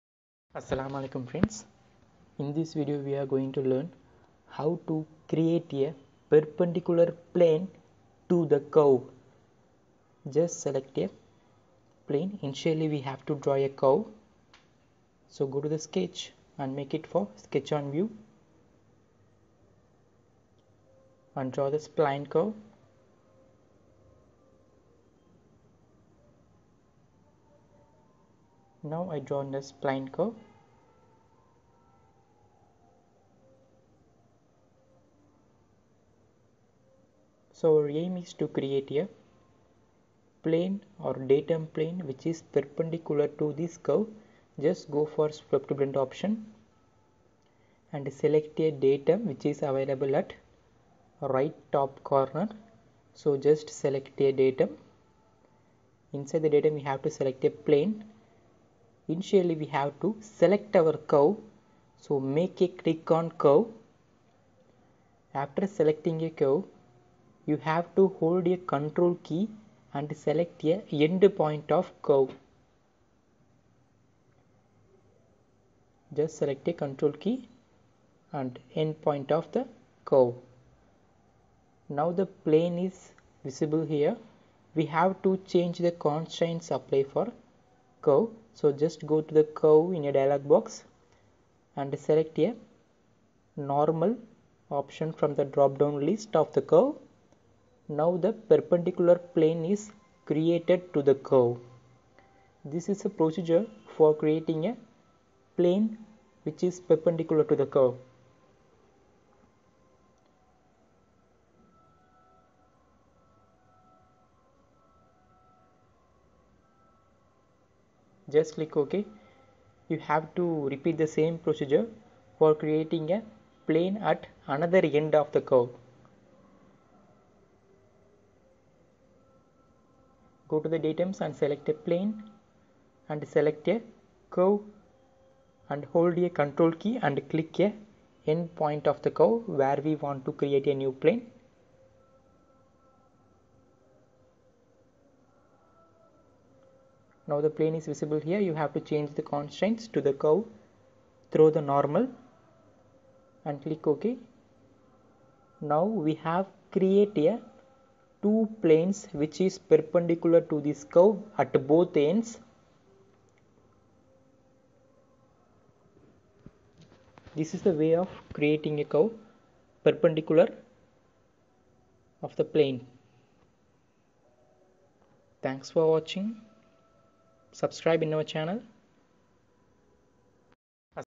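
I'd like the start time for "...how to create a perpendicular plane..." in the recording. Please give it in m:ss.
0:04.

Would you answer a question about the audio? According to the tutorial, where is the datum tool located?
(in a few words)
Right top corner.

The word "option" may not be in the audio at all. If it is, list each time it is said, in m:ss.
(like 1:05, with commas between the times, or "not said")
0:45, 1:34.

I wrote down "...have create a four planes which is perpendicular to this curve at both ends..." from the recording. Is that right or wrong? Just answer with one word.
wrong.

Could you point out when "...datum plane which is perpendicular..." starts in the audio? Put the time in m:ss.
0:41.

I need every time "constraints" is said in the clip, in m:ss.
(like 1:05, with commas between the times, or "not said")
1:26, 2:29.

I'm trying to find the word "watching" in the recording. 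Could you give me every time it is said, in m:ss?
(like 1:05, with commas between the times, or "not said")
2:55.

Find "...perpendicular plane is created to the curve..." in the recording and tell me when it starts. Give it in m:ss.
1:38.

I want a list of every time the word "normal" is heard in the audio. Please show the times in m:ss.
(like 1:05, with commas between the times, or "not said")
1:33, 2:31.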